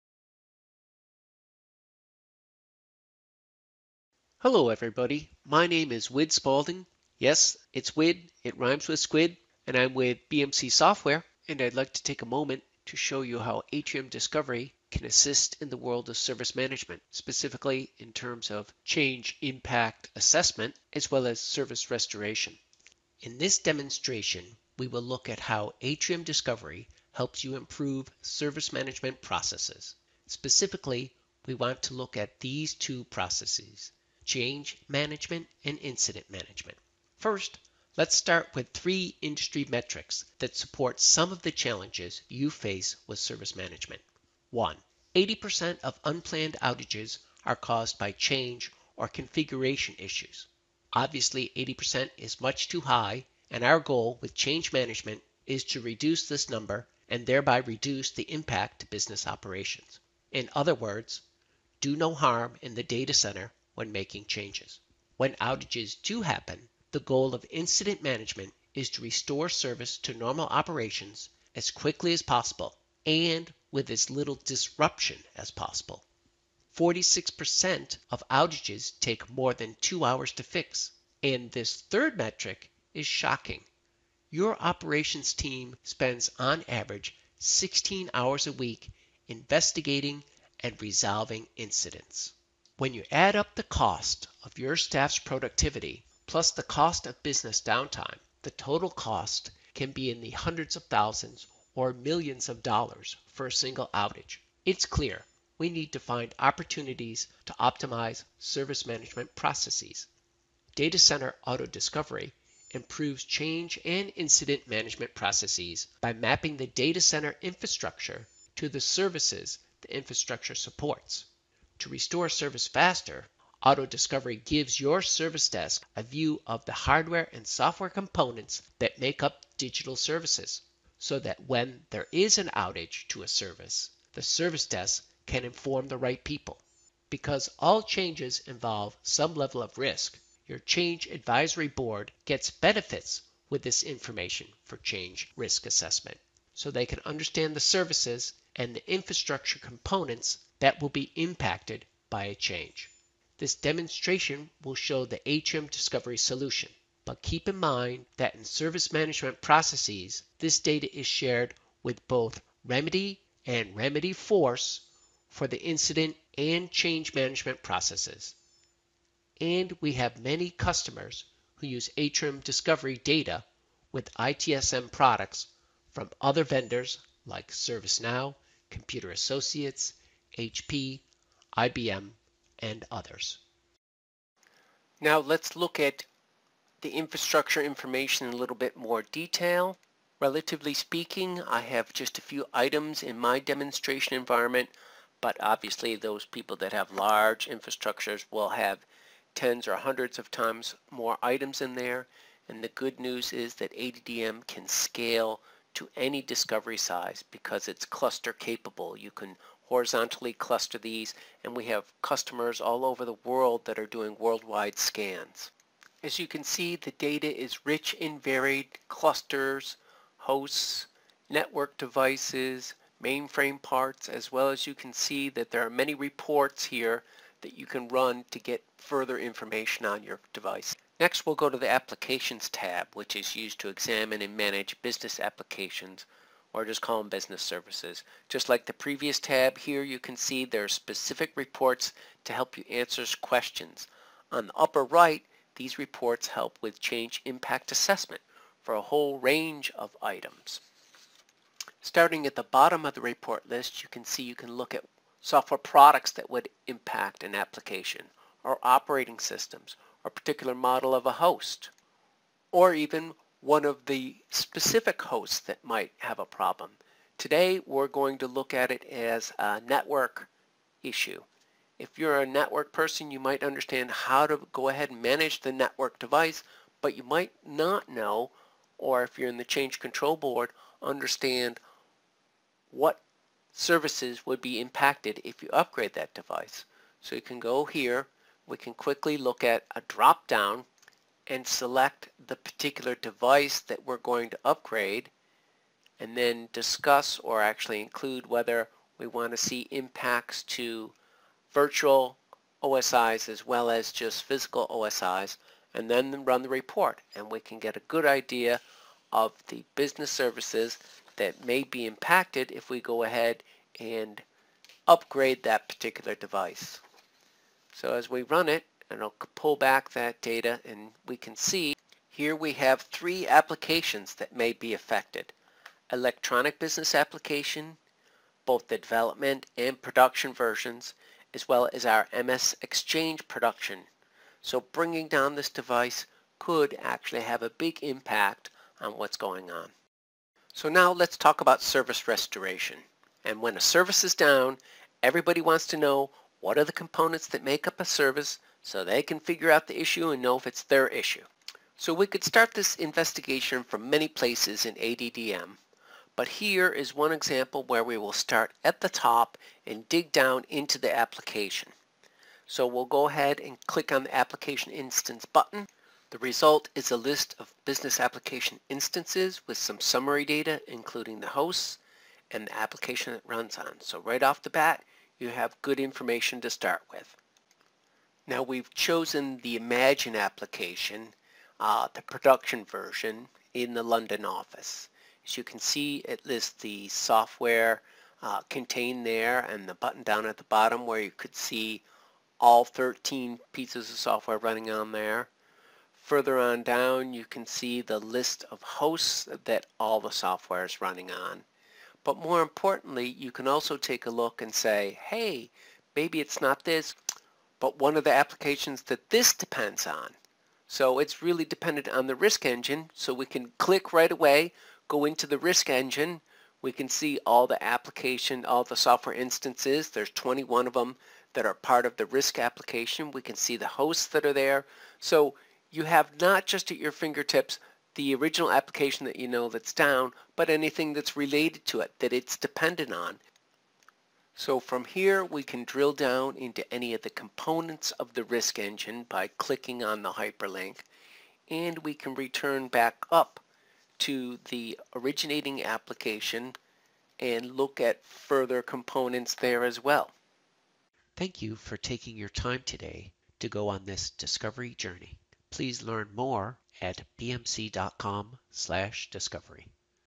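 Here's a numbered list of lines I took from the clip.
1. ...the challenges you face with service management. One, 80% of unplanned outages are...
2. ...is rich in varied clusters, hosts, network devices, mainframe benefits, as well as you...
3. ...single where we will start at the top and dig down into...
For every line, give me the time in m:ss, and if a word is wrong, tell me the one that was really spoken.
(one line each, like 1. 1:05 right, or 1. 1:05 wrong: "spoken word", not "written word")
1. 0:41 right
2. 3:37 wrong: "parts", not "benefits"
3. 5:57 wrong: "example", not "single".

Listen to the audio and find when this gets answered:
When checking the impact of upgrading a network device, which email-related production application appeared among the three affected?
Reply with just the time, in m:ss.
5:32.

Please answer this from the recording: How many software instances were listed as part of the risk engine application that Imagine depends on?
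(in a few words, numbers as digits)
21.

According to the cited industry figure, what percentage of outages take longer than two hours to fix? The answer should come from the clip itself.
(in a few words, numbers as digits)
46%.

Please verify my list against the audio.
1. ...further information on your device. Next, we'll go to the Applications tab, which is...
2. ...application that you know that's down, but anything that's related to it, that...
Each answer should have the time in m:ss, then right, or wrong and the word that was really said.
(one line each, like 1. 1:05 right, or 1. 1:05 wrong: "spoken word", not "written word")
1. 3:48 right
2. 7:08 right.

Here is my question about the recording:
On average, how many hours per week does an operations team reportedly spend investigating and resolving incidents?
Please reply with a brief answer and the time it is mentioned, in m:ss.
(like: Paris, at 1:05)
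16 hours, at 1:27.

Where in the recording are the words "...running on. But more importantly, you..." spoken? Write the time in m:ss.
6:40.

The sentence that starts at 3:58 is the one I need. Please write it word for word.
Just like the previous tab here, you can see there are specific reports to help you answer questions.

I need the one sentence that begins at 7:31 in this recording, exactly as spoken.
Thank you for taking your time today to go on this discovery journey.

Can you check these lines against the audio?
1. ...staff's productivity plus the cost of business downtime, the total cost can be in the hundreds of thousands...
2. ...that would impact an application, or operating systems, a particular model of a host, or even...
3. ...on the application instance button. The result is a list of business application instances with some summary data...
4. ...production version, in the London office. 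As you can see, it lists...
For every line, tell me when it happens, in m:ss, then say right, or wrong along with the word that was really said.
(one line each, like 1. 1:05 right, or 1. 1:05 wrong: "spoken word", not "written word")
1. 1:34 right
2. 4:16 right
3. 6:03 right
4. 6:22 right.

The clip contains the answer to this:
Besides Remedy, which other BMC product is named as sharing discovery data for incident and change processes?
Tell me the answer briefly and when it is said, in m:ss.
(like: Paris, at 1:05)
Remedyforce, at 2:43.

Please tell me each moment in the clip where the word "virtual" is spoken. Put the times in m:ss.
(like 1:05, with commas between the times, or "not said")
5:01.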